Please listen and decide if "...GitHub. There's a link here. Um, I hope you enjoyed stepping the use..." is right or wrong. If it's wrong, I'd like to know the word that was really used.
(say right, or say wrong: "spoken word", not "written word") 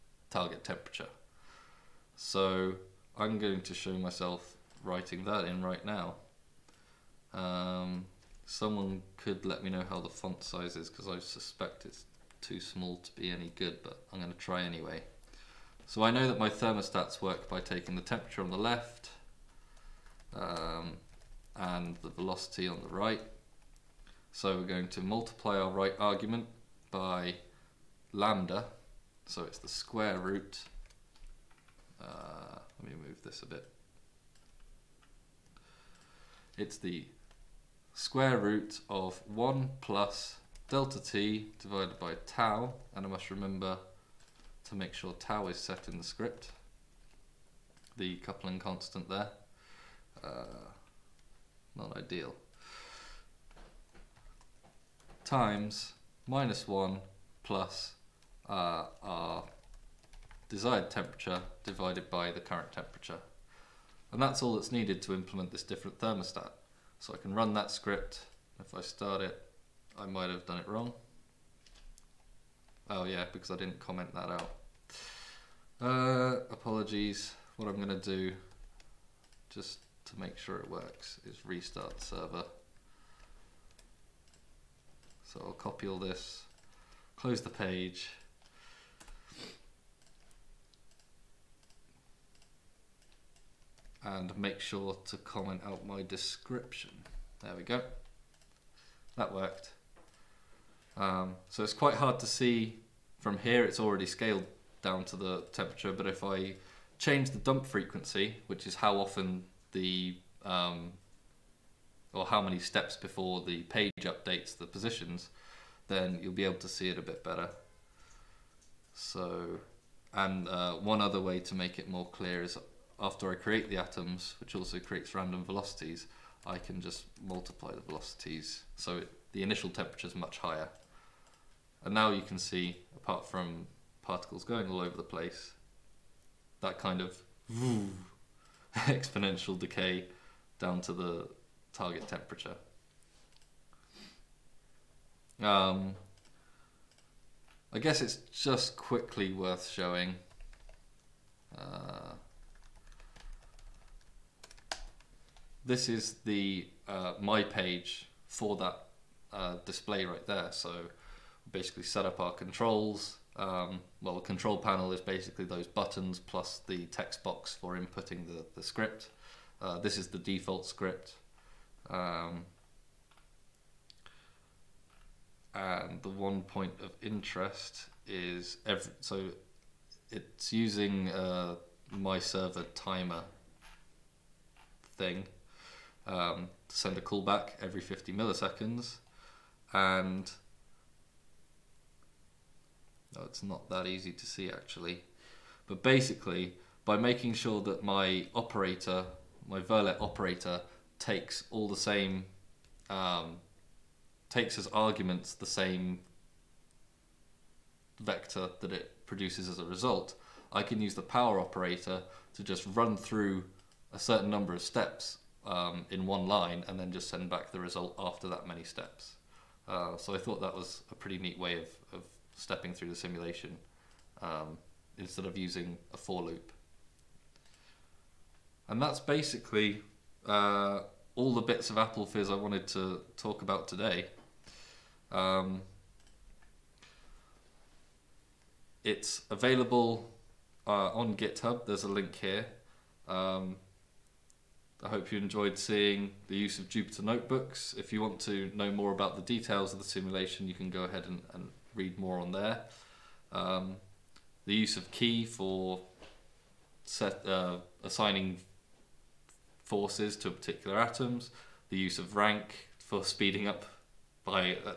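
wrong: "seeing", not "stepping".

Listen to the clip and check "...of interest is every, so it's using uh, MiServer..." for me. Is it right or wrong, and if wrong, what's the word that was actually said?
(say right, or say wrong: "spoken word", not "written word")
right.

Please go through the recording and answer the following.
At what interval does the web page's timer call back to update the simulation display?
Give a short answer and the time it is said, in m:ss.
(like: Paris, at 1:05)
50 milliseconds, at 3:07.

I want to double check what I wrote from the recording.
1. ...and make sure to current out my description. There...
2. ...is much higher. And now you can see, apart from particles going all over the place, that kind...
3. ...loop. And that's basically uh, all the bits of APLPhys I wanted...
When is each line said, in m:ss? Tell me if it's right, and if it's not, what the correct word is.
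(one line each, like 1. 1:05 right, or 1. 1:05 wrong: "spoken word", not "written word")
1. 1:34 wrong: "comment", not "current"
2. 2:10 right
3. 3:46 right.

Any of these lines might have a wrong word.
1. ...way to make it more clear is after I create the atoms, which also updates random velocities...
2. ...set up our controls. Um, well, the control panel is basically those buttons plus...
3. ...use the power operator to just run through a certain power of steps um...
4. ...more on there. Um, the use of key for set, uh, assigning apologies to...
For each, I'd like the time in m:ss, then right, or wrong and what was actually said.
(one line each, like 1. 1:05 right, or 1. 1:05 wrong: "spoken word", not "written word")
1. 2:01 wrong: "creates", not "updates"
2. 2:41 right
3. 3:30 wrong: "number", not "power"
4. 4:11 wrong: "forces", not "apologies".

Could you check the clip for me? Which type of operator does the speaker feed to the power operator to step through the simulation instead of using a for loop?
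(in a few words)
Verlet operator.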